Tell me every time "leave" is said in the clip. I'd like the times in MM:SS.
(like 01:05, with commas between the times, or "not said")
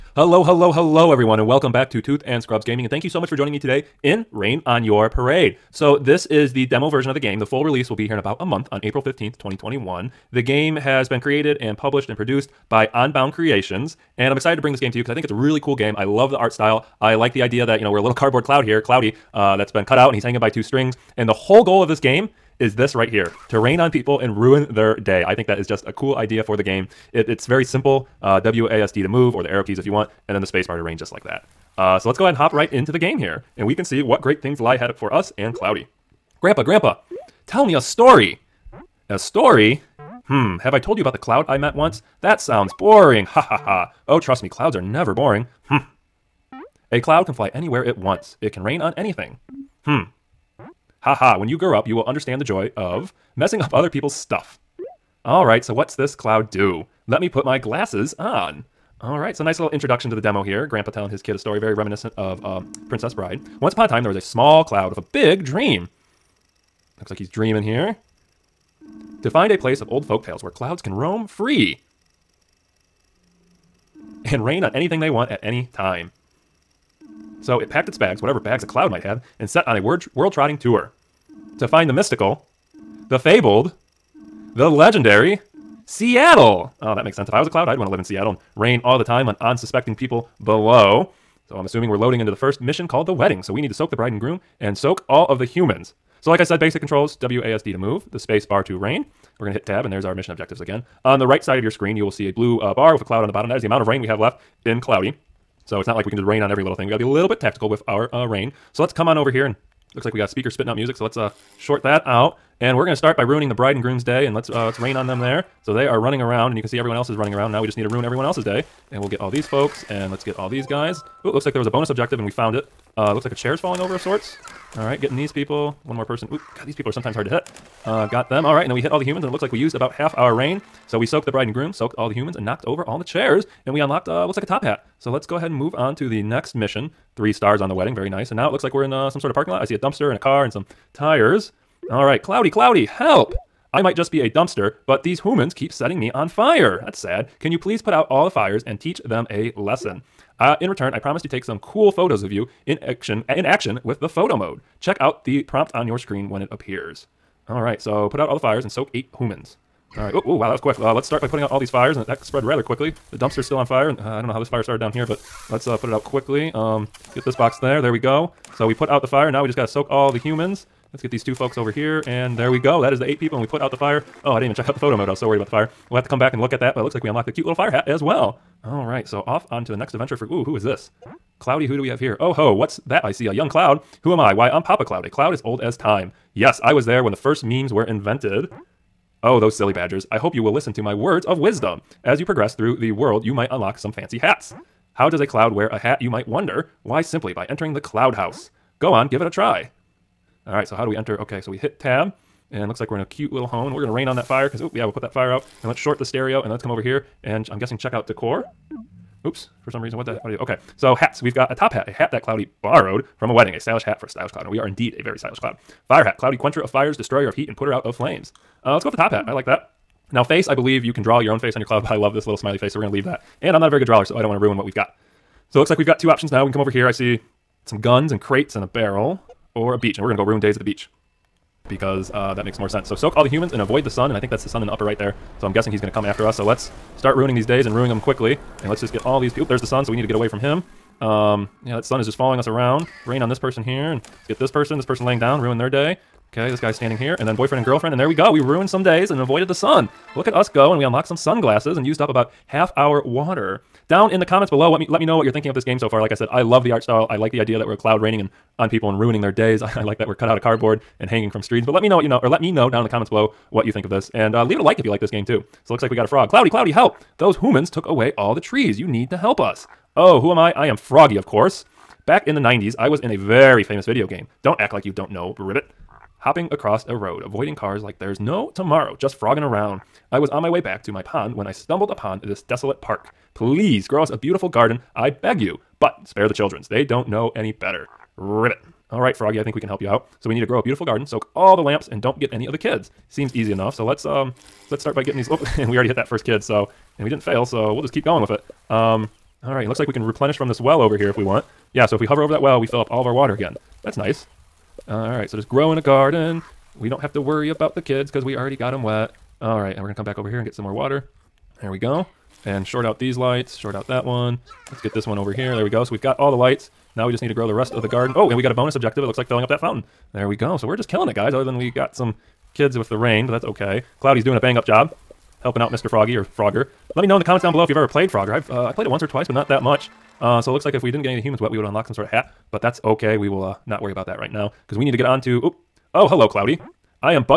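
03:42, 04:24.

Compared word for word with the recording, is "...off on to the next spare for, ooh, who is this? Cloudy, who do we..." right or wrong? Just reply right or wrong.
wrong.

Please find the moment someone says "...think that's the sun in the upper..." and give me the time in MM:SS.
03:54.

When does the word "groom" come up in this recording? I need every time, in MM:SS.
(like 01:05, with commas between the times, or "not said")
01:34, 01:53, 02:11.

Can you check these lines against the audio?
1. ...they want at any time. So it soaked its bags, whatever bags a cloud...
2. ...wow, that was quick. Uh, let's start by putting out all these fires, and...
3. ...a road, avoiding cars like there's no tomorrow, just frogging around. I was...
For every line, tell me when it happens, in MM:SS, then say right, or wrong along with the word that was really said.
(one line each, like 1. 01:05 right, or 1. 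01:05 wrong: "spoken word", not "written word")
1. 01:15 wrong: "packed", not "soaked"
2. 02:40 right
3. 04:36 right.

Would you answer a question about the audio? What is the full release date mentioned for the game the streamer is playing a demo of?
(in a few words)
April 15th, 2021.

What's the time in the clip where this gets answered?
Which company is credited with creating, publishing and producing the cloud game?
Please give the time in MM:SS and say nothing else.
00:12.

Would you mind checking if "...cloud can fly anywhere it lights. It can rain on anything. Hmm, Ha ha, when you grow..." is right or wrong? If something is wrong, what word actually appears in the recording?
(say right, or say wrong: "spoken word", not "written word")
wrong: "wants", not "lights".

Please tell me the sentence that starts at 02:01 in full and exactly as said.
Ooh, looks like there was a bonus objective, and we found it.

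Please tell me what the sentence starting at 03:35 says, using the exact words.
Fire hat, Cloudy quencher of fires, destroyer of heat, and putter out of flames.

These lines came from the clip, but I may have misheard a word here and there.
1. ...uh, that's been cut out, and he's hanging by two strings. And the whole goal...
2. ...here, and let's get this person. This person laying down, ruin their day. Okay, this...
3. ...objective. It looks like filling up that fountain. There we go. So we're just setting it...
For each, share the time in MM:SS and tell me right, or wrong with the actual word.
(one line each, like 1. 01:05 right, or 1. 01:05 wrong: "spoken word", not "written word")
1. 00:19 right
2. 04:03 right
3. 05:18 wrong: "killing", not "setting".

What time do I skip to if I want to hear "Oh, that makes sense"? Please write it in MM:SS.
01:26.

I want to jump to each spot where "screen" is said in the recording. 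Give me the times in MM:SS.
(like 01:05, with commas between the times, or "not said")
01:41, 02:35.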